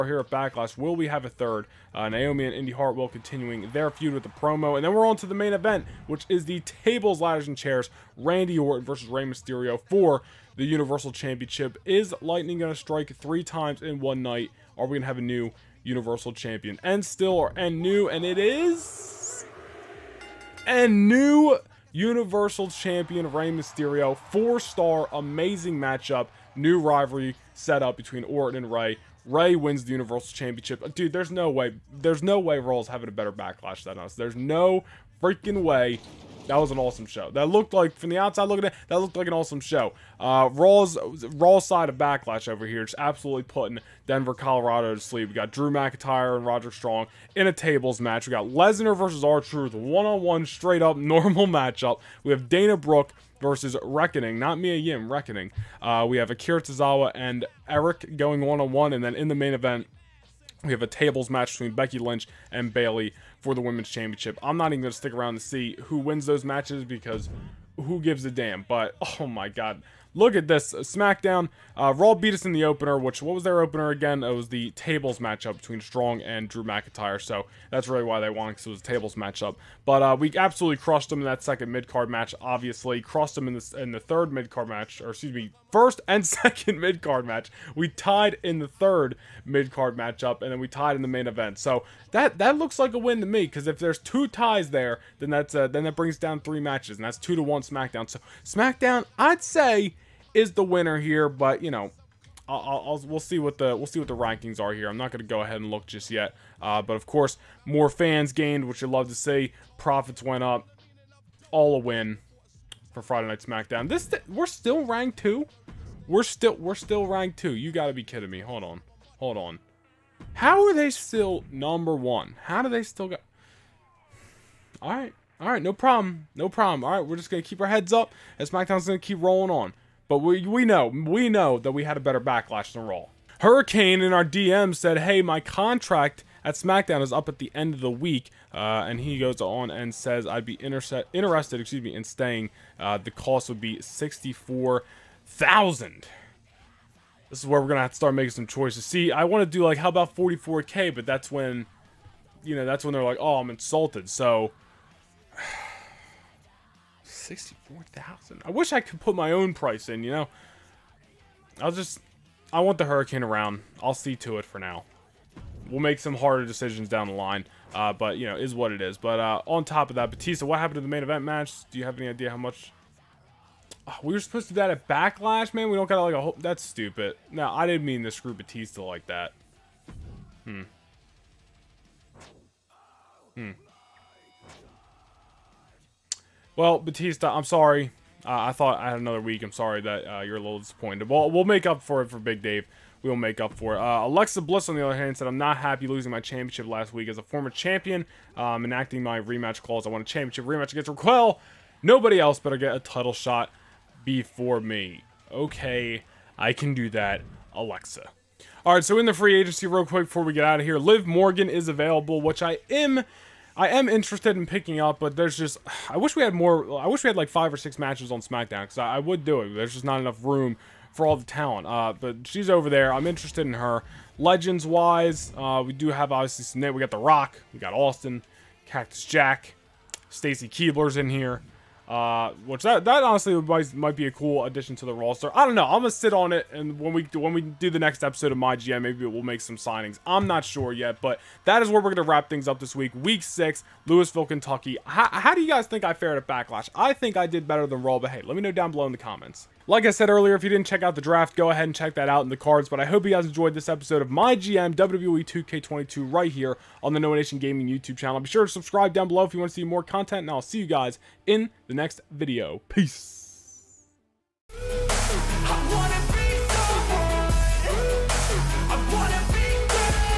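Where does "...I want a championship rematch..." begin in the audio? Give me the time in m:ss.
3:19.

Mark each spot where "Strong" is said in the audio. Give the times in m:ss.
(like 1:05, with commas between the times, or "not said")
0:46, 1:15.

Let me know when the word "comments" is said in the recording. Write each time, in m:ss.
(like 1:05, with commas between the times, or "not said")
4:08.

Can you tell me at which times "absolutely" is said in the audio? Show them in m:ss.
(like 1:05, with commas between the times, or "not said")
0:42, 1:20.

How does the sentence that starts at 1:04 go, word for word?
I'm not even going to stick around to see who wins those matches because who gives a damn.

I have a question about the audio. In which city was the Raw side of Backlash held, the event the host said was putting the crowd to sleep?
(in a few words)
Denver, Colorado.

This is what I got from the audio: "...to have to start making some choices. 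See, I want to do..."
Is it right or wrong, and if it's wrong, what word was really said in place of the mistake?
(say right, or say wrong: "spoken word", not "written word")
right.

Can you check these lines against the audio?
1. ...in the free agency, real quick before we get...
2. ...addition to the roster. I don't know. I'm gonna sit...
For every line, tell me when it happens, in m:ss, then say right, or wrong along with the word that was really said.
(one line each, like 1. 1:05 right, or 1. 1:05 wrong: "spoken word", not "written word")
1. 3:28 right
2. 3:54 right.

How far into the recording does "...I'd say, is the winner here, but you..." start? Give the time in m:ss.
1:39.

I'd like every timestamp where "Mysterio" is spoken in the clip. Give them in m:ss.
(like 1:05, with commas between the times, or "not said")
0:09, 0:23.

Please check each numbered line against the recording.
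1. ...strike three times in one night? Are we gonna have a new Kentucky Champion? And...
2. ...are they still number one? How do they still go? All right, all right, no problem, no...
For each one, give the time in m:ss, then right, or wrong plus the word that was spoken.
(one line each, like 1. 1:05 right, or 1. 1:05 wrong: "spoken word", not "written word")
1. 0:12 wrong: "Universal", not "Kentucky"
2. 2:00 right.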